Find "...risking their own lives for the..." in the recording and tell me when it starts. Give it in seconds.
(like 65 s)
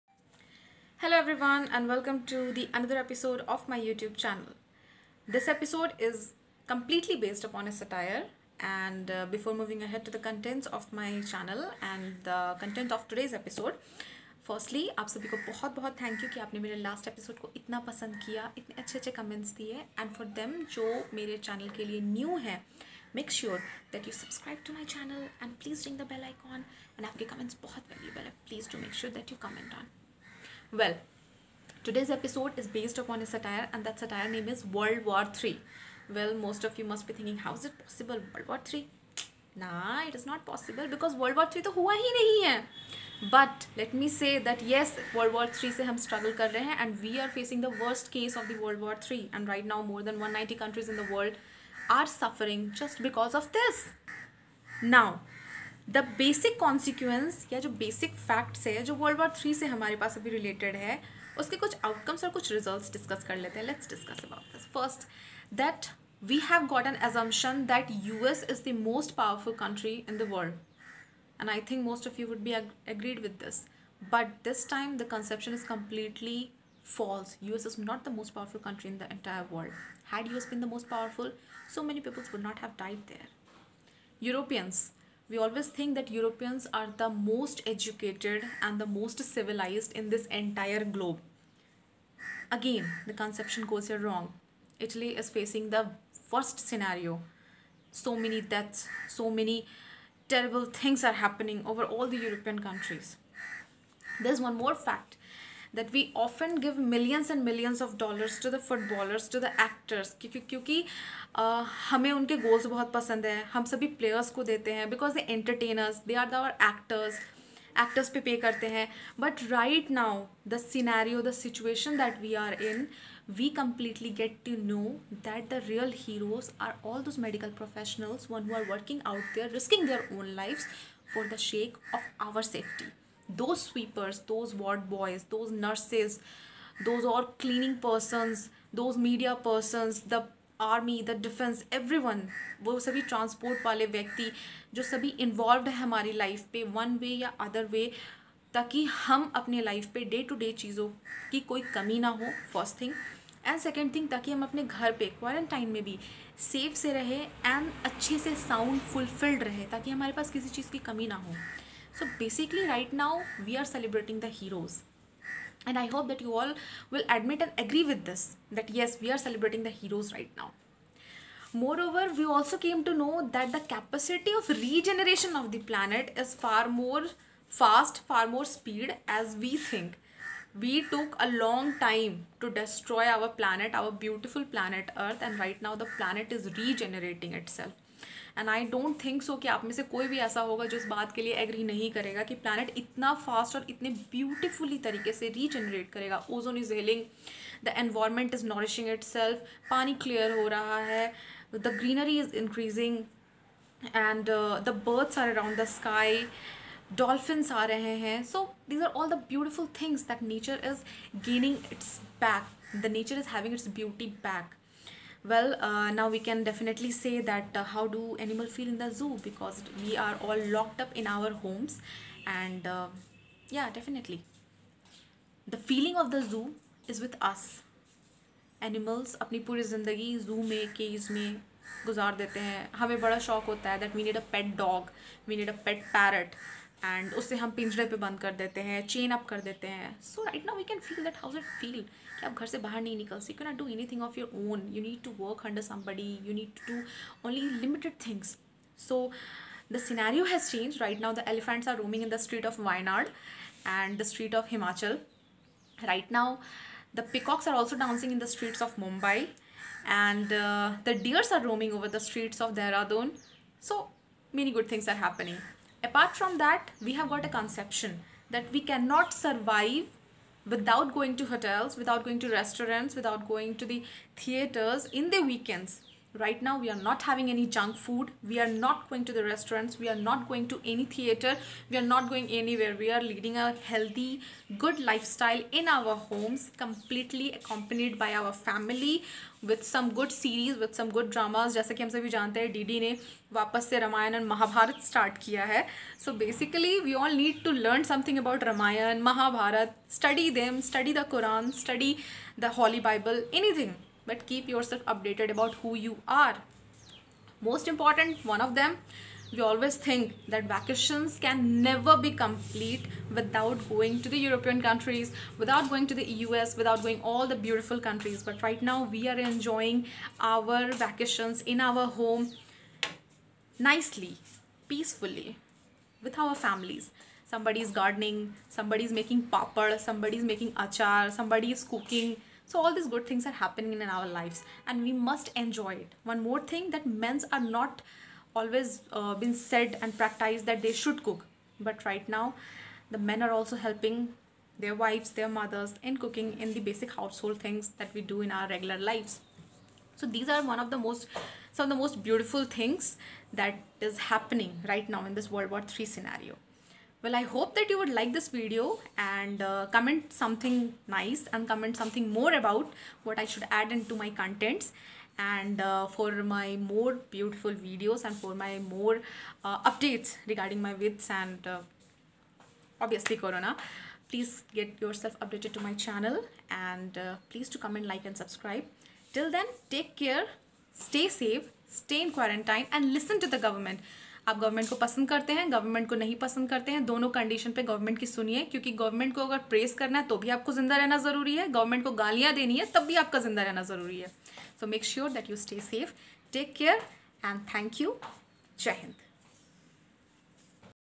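129 s.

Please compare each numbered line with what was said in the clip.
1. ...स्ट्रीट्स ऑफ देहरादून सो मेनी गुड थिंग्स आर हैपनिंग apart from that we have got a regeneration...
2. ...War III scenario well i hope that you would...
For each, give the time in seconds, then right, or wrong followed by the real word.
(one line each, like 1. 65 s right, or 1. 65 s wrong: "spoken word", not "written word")
1. 262 s wrong: "conception", not "regeneration"
2. 355 s right.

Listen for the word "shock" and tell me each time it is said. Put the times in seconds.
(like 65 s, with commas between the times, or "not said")
233 s.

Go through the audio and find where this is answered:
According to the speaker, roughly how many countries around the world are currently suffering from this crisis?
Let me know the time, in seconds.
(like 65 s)
49 s.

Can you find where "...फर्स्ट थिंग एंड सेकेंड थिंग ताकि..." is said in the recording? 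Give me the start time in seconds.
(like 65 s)
152 s.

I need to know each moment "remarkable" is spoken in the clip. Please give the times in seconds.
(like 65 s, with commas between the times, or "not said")
not said.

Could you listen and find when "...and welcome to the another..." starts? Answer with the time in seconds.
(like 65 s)
1 s.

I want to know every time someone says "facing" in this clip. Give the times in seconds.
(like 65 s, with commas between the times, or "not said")
47 s, 95 s.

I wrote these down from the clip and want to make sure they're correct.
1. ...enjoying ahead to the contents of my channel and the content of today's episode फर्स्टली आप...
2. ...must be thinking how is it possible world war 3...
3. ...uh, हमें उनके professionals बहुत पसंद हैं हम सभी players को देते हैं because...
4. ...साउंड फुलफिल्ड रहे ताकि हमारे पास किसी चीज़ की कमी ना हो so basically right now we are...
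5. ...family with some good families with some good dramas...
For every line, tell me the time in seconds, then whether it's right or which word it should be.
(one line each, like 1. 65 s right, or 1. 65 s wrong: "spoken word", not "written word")
1. 9 s wrong: "moving", not "enjoying"
2. 36 s right
3. 111 s wrong: "goals", not "professionals"
4. 158 s right
5. 288 s wrong: "series", not "families".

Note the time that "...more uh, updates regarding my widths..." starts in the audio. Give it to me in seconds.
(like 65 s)
368 s.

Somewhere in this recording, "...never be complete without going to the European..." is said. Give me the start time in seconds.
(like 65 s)
311 s.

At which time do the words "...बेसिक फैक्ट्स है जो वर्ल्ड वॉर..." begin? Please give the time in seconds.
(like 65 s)
57 s.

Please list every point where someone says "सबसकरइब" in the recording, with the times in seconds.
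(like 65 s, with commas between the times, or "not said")
24 s.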